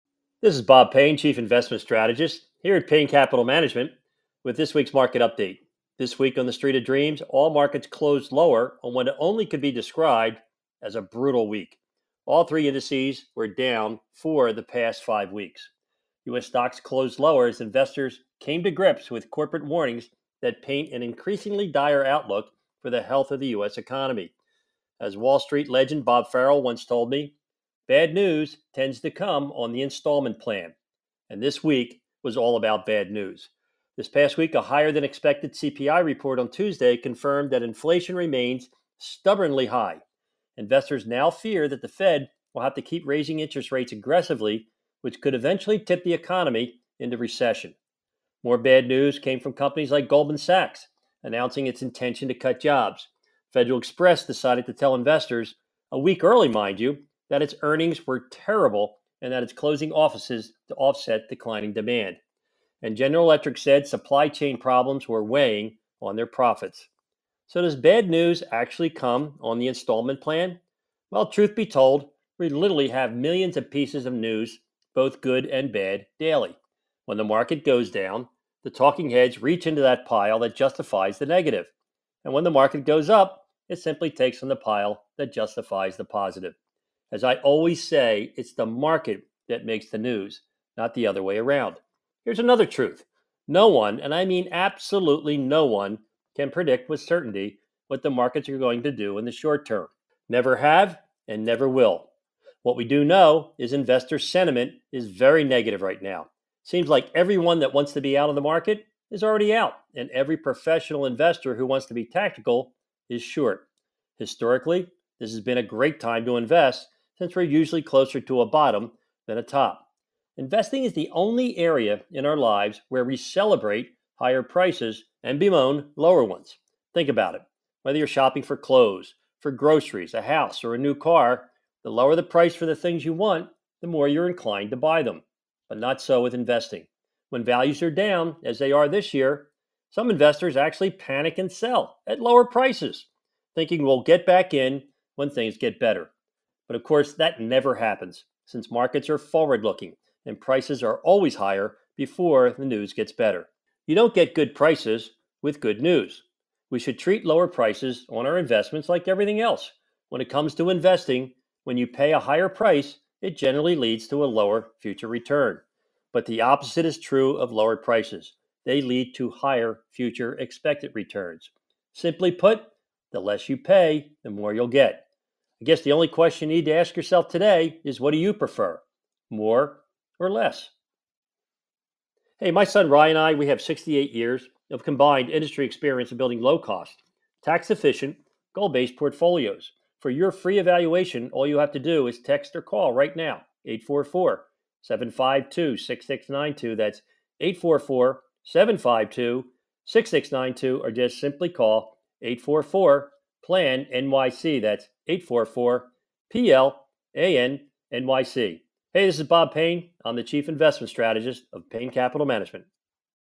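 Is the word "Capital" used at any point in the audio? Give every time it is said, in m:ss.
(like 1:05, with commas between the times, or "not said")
0:03, 3:31.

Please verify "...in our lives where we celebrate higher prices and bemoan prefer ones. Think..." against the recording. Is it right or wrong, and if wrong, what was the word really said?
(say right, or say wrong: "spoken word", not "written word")
wrong: "lower", not "prefer".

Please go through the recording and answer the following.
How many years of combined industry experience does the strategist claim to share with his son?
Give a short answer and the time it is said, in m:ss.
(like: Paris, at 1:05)
68, at 3:03.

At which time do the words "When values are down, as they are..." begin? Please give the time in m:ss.
2:17.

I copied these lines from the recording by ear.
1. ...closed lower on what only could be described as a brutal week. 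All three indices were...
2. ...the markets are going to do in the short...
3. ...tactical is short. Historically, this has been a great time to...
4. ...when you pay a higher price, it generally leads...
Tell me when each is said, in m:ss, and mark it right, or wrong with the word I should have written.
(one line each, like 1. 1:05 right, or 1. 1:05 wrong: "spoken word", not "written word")
1. 0:07 right
2. 1:38 right
3. 1:52 right
4. 2:41 right.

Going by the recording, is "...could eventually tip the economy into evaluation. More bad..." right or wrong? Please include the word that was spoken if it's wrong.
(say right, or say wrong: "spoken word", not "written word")
wrong: "recession", not "evaluation".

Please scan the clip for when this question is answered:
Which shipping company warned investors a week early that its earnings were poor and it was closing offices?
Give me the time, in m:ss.
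0:53.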